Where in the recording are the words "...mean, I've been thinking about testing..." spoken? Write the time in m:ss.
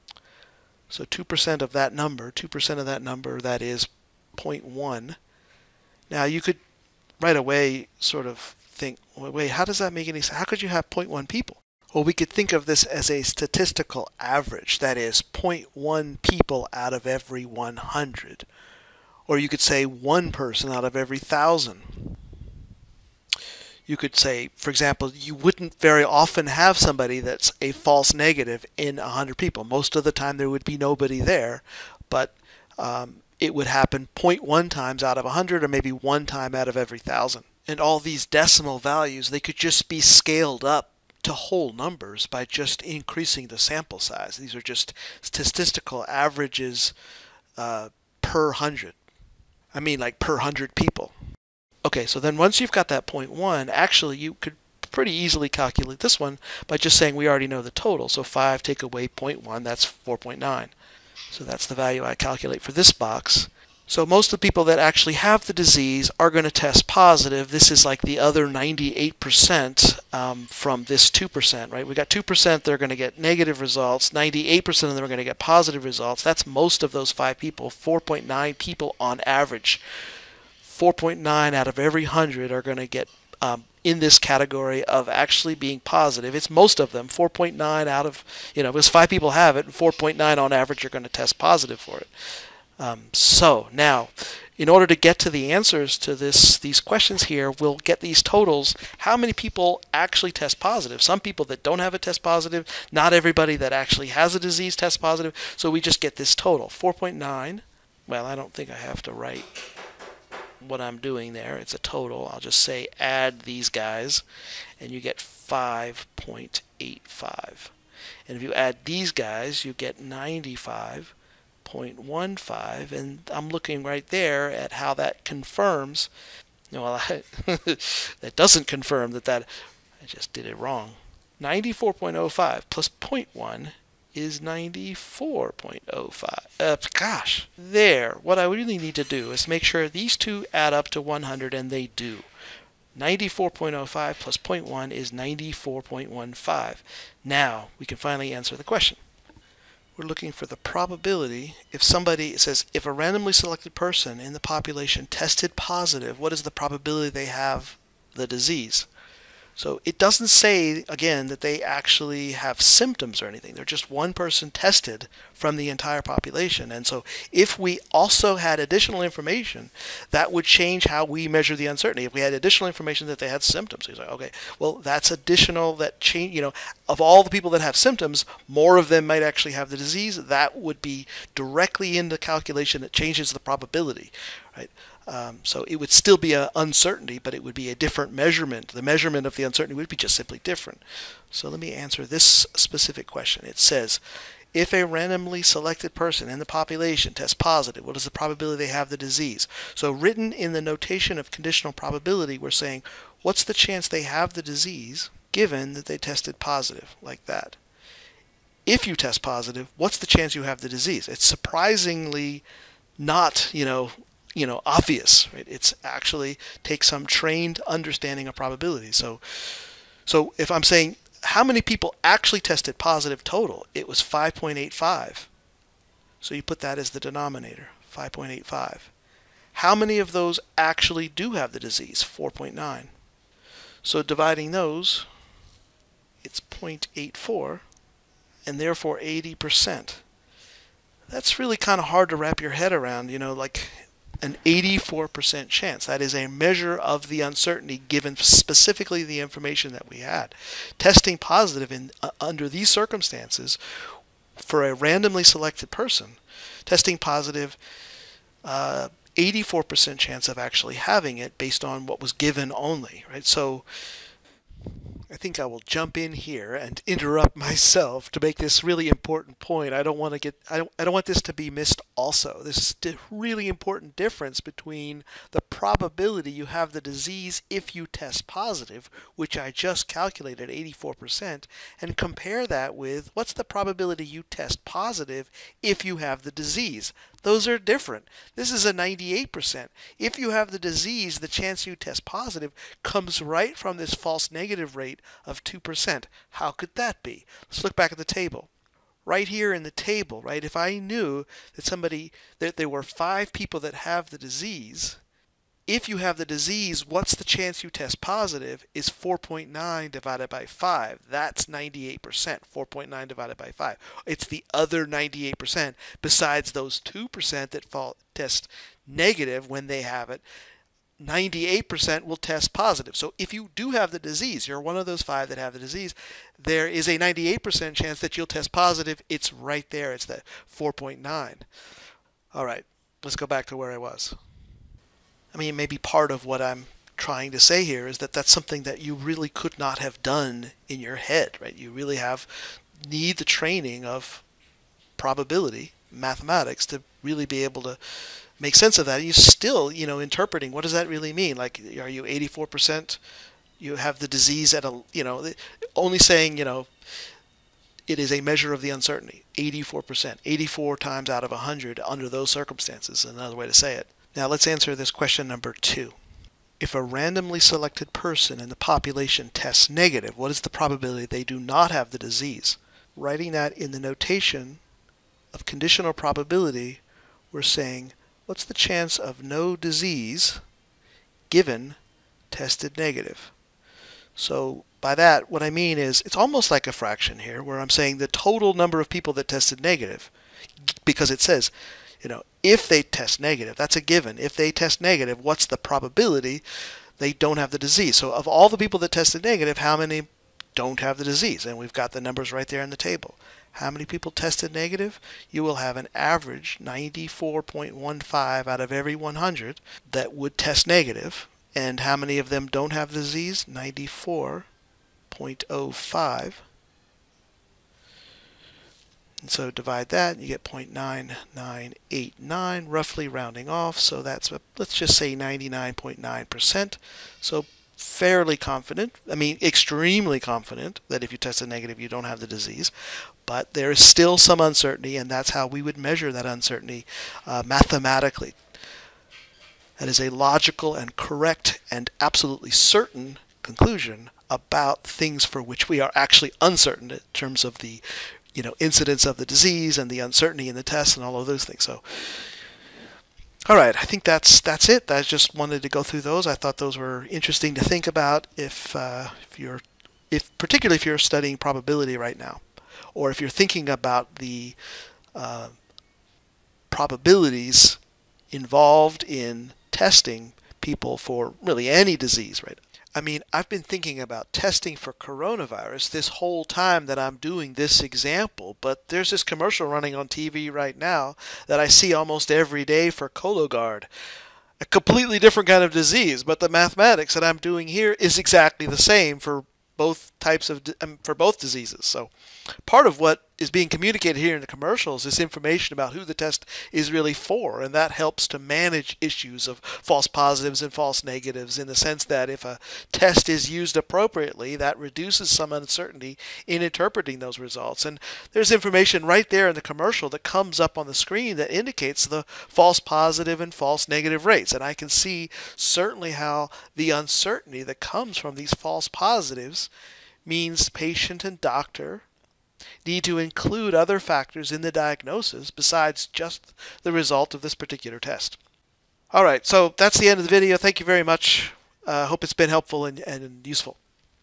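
7:53.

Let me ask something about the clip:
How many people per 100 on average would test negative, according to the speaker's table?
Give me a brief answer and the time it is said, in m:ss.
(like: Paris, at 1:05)
94.15, at 6:46.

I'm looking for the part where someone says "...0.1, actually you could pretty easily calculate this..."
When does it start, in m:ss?
0:53.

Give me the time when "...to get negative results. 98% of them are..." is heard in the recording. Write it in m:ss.
1:12.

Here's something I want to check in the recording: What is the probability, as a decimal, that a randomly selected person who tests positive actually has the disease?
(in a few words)
0.84.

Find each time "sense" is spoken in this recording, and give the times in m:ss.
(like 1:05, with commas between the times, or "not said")
0:10, 5:48, 8:21.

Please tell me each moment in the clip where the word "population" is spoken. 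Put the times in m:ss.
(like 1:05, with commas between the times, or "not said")
2:34, 2:46, 3:16, 6:08.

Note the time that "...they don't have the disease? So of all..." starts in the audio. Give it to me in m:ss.
6:36.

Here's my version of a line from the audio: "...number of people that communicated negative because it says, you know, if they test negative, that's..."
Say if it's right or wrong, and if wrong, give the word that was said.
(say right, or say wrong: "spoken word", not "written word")
wrong: "tested", not "communicated".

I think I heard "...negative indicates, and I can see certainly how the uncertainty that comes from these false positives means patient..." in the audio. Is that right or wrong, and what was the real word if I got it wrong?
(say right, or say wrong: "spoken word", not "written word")
wrong: "rates", not "indicates".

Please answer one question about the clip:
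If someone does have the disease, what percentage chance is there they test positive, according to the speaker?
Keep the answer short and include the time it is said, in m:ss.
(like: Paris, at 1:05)
98%, at 4:48.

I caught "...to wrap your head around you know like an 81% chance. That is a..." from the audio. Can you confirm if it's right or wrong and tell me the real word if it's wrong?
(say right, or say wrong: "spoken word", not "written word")
wrong: "84", not "81".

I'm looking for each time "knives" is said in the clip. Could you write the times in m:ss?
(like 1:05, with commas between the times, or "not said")
not said.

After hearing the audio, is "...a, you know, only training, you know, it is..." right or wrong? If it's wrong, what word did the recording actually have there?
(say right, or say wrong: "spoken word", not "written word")
wrong: "saying", not "training".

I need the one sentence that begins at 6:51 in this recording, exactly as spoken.
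And how many of them don't have the disease?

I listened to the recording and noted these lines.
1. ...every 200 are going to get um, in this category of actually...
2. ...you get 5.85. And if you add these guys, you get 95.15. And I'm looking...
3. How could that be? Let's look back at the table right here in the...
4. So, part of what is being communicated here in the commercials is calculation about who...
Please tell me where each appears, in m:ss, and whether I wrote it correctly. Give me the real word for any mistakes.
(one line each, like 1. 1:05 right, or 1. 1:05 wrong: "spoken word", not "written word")
1. 1:21 wrong: "100", not "200"
2. 1:54 right
3. 4:56 right
4. 8:11 wrong: "information", not "calculation".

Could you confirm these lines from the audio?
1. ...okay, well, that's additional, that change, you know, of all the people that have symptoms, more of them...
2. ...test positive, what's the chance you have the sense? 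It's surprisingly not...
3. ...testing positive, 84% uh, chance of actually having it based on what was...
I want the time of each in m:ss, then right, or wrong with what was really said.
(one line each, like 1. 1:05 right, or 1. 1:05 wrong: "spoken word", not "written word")
1. 2:54 right
2. 3:28 wrong: "disease", not "sense"
3. 4:16 right.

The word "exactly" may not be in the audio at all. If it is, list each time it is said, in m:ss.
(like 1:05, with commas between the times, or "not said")
8:08.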